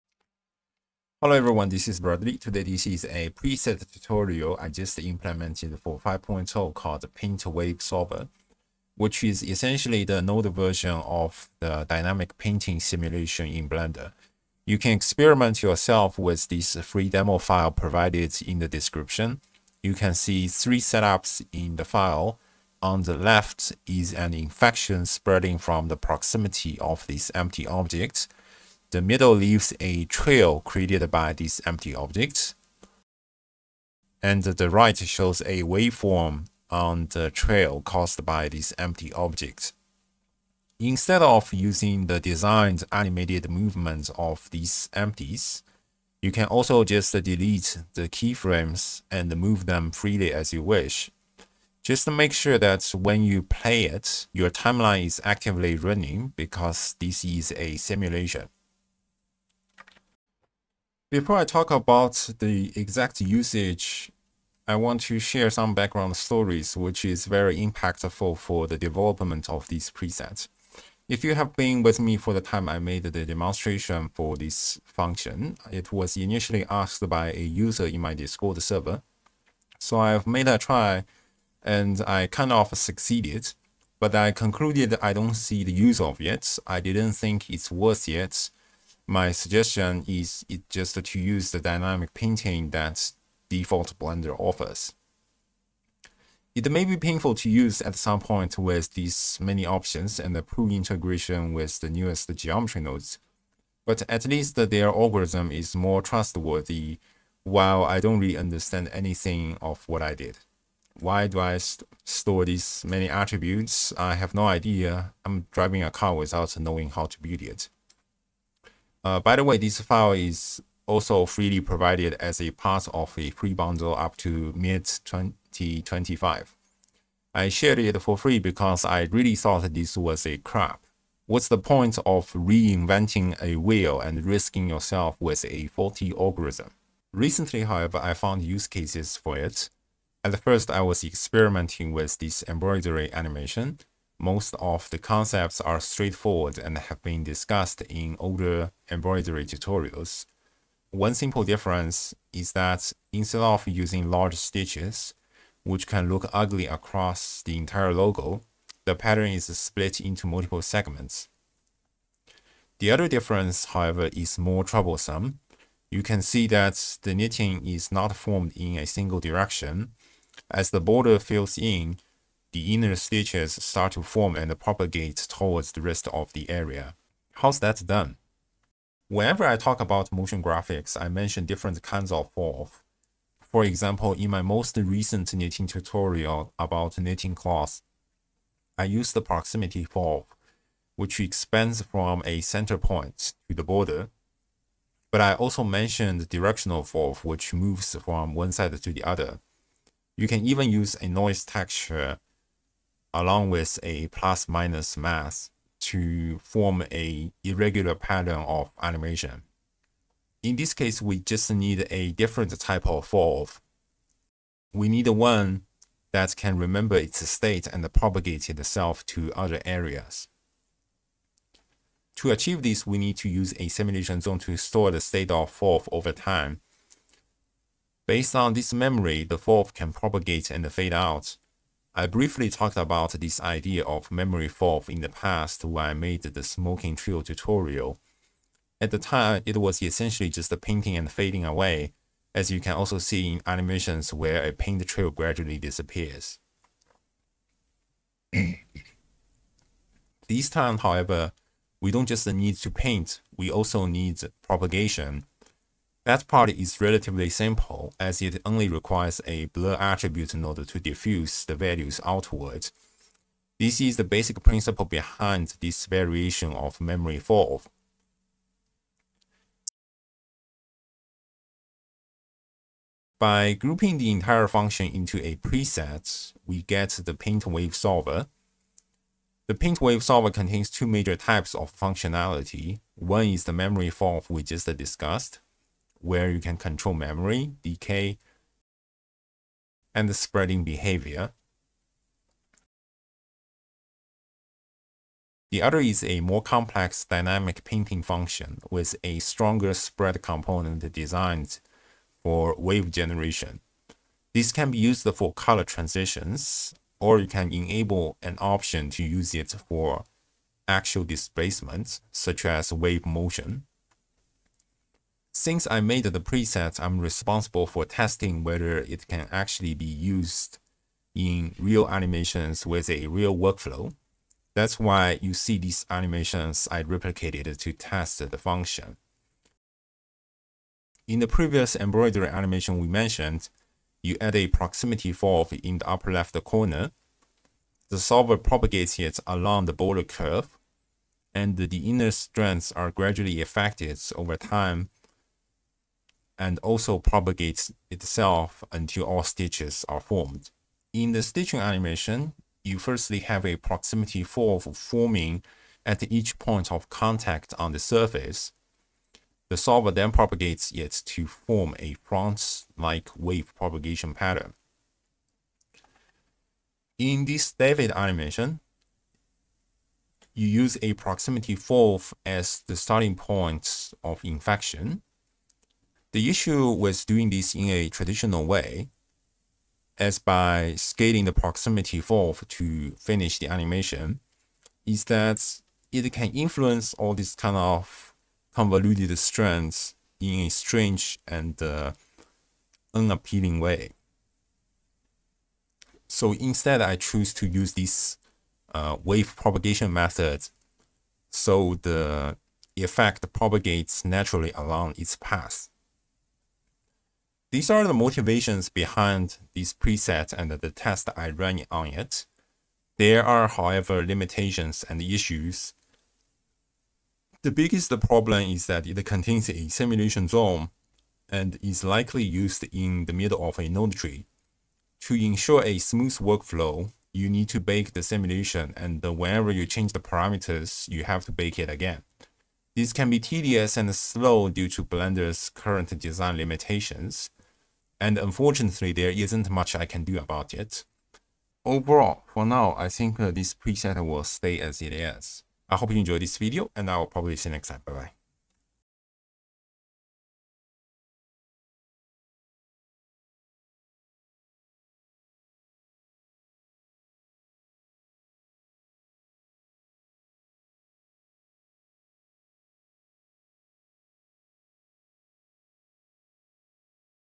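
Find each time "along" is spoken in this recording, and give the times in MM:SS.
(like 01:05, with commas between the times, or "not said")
03:23, 05:39, 06:44.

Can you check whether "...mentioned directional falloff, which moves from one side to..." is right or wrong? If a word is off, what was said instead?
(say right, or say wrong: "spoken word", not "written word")
right.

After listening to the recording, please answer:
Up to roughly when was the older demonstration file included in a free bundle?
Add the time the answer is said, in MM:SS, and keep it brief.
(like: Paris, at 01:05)
mid 2025, at 02:04.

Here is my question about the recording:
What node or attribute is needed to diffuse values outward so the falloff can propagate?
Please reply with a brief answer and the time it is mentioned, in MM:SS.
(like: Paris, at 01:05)
blur attribute, at 04:19.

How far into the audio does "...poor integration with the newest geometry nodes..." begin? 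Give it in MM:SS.
01:40.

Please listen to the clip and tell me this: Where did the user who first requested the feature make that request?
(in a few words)
Discord server.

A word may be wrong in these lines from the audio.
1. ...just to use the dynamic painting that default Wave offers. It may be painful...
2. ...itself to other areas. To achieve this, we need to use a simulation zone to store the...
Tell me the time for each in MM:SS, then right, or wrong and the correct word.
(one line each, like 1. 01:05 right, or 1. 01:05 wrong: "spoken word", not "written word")
1. 01:30 wrong: "Blender", not "Wave"
2. 03:38 right.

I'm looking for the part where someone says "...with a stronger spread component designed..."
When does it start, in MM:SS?
04:58.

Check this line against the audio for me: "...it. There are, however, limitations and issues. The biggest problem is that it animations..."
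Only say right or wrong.
wrong.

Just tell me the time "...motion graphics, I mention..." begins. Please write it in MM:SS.
03:00.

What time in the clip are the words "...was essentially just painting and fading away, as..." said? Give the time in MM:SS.
03:59.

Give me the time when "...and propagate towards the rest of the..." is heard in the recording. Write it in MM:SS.
02:54.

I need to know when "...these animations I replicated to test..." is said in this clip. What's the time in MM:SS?
05:25.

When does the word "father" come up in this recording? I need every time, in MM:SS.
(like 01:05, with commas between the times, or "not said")
not said.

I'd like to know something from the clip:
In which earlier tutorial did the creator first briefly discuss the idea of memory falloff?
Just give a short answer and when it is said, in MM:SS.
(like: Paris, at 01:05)
smoking trio tutorial, at 03:56.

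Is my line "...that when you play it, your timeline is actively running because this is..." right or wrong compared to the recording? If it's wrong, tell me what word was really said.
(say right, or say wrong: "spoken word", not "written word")
right.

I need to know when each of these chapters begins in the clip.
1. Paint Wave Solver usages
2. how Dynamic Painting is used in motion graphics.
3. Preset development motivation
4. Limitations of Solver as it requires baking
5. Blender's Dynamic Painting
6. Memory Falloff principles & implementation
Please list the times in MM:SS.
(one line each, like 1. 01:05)
1. 04:40
2. 05:30
3. 02:00
4. 06:50
5. 01:00
6. 03:30.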